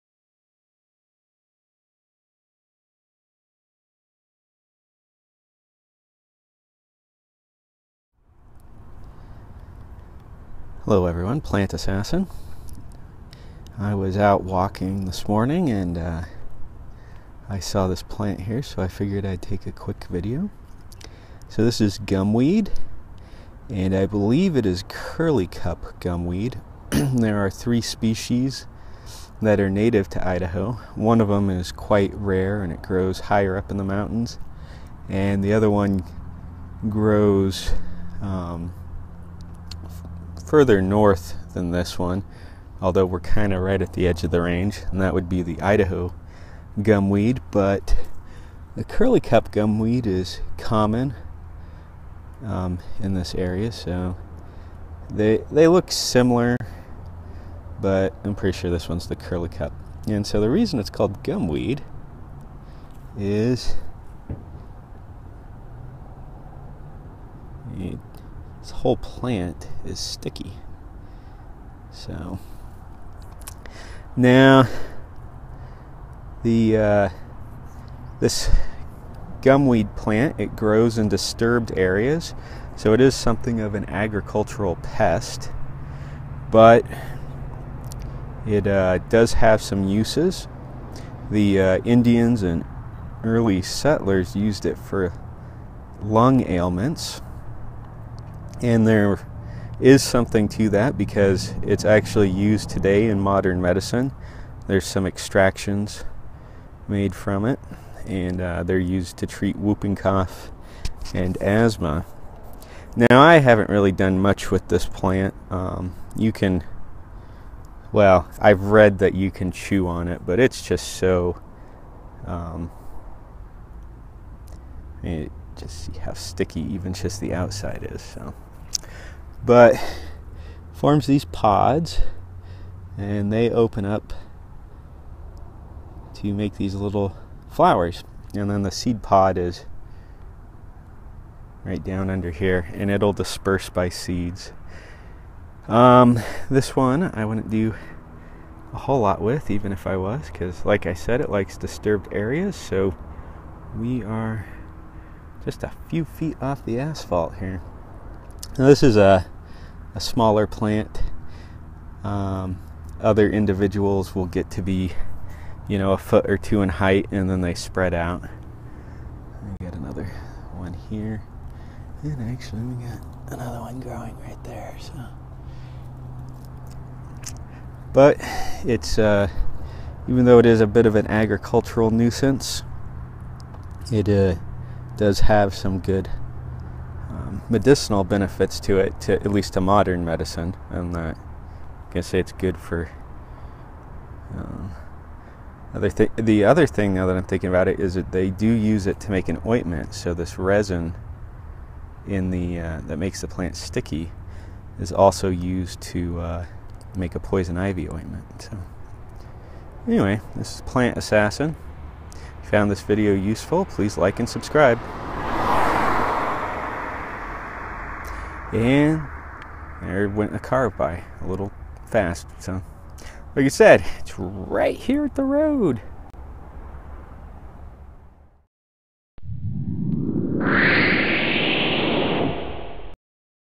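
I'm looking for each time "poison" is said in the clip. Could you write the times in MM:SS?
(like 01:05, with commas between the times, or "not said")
03:27.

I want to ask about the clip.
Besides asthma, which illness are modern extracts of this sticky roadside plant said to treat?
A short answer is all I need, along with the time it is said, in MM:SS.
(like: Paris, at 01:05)
Whooping cough, at 01:49.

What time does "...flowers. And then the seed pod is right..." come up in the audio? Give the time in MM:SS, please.
02:17.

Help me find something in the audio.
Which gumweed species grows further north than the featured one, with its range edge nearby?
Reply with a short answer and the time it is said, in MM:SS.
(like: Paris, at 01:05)
Idaho gumweed, at 00:45.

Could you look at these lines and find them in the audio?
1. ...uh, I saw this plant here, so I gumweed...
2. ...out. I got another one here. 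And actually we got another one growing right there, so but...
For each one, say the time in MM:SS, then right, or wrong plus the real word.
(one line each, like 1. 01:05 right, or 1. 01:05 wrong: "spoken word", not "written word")
1. 00:15 wrong: "figured", not "gumweed"
2. 02:47 right.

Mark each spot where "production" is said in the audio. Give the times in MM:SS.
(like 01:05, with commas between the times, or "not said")
not said.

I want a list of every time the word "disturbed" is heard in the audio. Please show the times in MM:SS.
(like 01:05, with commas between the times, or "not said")
01:21, 02:31.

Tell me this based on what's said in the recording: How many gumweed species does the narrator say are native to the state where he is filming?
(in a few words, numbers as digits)
3.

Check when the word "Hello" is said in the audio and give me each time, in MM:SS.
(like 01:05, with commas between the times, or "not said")
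00:10.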